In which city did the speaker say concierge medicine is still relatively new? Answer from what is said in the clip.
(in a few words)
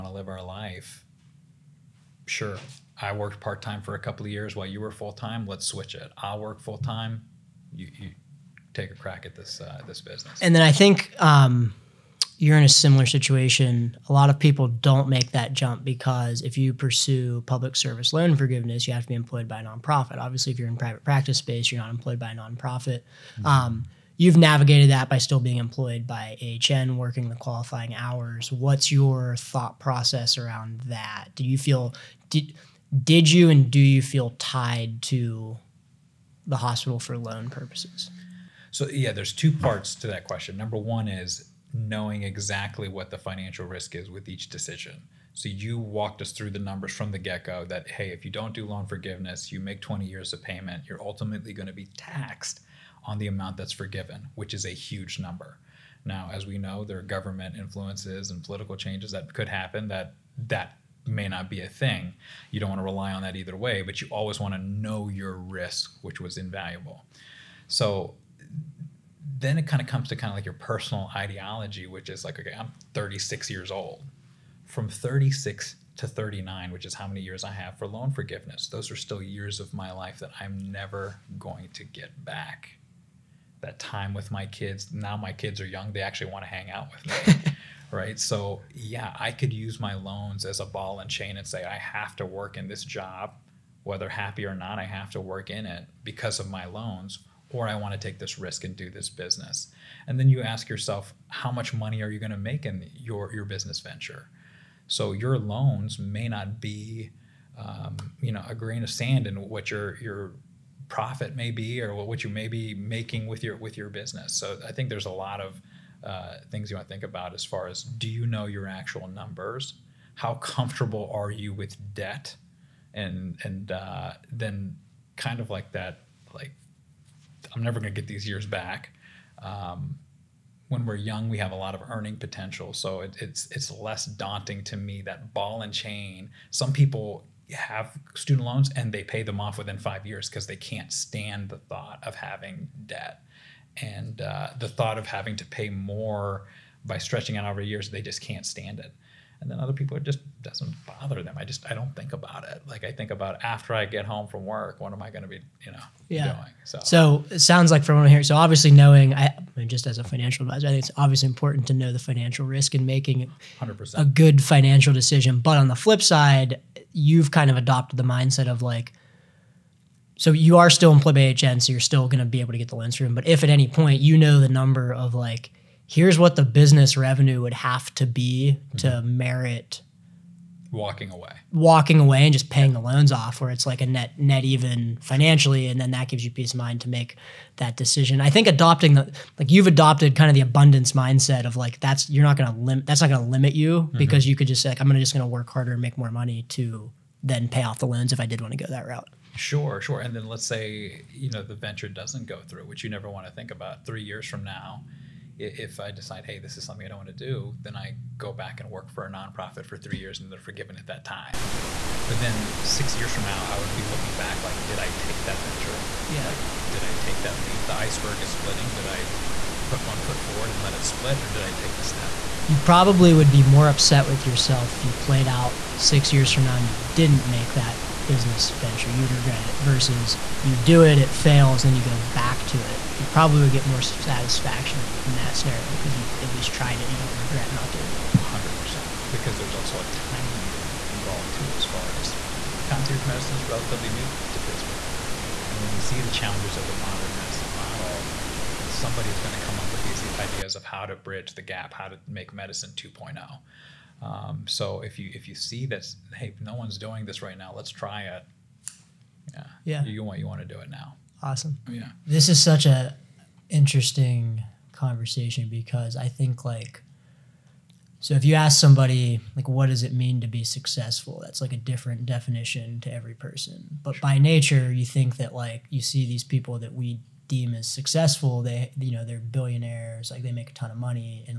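Pittsburgh.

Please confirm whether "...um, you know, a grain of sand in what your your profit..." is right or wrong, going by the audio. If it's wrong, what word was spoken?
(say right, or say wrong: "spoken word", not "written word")
right.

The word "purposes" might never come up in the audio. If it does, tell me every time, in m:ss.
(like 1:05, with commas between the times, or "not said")
0:37.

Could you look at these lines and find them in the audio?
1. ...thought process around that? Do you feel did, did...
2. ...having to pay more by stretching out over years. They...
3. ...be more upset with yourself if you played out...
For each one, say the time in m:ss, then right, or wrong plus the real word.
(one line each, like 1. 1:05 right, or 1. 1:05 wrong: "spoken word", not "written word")
1. 0:29 right
2. 2:25 right
3. 3:43 right.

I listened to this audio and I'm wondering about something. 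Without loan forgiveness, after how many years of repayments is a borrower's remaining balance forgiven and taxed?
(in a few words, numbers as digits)
20 years.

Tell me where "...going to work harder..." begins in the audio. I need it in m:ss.
3:15.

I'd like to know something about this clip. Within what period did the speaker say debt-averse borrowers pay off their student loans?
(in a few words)
5 years.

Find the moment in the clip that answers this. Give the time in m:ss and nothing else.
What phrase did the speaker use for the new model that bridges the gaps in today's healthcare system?
4:12.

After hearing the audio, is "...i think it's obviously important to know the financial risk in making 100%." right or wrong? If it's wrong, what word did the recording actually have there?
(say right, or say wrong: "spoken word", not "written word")
right.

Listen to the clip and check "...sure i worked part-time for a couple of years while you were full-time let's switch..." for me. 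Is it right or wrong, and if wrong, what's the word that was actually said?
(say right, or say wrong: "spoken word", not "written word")
right.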